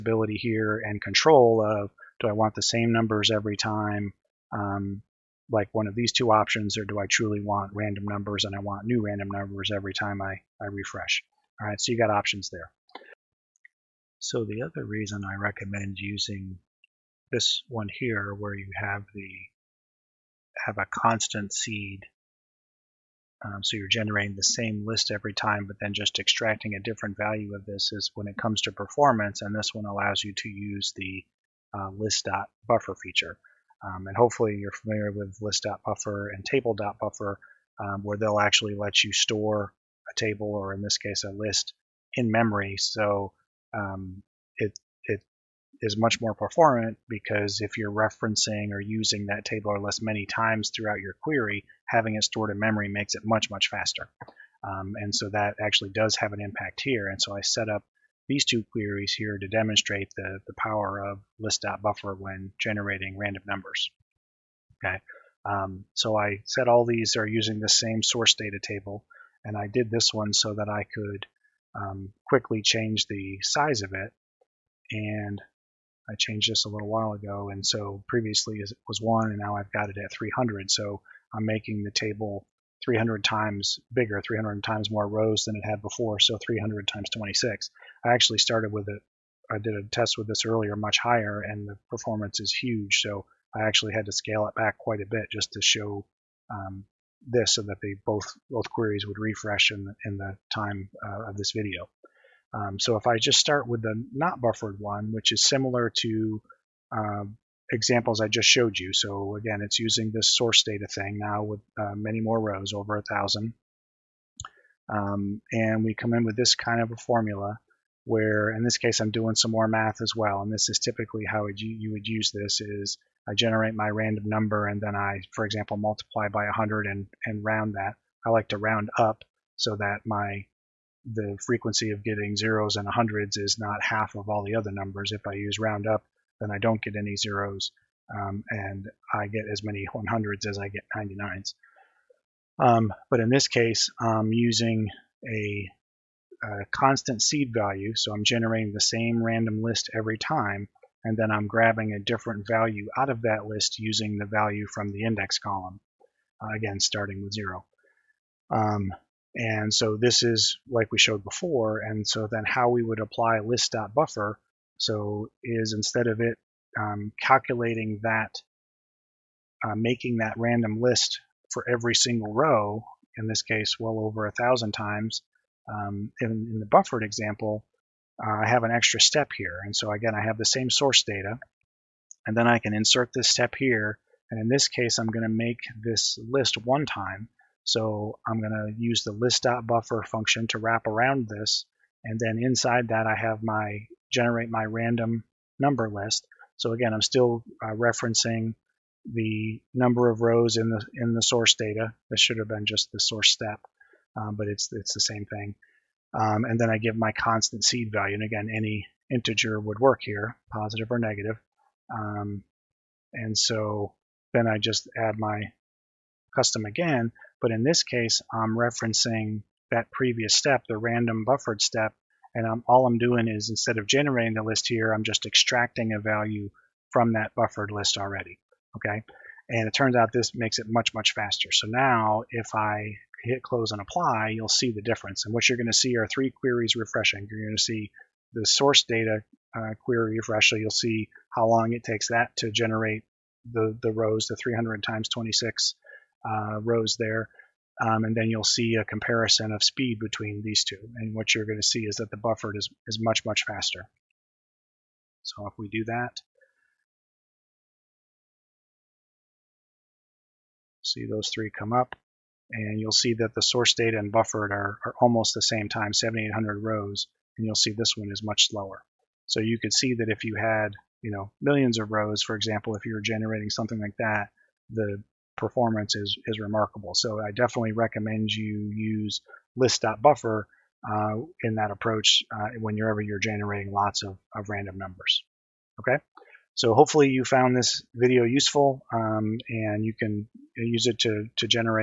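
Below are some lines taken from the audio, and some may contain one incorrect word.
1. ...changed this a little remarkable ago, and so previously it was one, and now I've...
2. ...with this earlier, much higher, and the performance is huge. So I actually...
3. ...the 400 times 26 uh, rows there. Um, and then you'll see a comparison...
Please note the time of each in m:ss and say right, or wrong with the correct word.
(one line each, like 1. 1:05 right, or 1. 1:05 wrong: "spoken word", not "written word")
1. 1:16 wrong: "while", not "remarkable"
2. 1:30 right
3. 4:04 wrong: "300", not "400".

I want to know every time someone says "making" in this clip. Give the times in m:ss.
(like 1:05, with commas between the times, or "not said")
1:21, 2:49.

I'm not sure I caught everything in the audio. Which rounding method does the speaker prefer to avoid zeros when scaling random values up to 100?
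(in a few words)
Round up.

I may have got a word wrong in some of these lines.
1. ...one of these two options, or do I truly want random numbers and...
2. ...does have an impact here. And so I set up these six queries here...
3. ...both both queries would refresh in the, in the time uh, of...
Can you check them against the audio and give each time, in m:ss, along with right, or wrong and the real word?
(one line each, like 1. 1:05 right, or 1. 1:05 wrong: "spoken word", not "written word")
1. 0:05 right
2. 0:55 wrong: "two", not "six"
3. 1:38 right.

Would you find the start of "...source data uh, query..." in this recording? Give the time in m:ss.
3:58.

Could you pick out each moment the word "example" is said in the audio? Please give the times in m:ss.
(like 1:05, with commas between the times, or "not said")
1:47, 2:05, 2:57, 4:32.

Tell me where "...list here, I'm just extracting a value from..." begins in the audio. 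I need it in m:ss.
3:44.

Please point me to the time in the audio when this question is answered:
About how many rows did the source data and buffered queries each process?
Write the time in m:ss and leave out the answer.
4:25.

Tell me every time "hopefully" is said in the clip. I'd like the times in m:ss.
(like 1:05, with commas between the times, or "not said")
0:34, 4:46.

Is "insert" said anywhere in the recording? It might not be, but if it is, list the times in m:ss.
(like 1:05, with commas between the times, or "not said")
3:02.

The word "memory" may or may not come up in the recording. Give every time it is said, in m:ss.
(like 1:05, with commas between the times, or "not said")
0:42, 0:52.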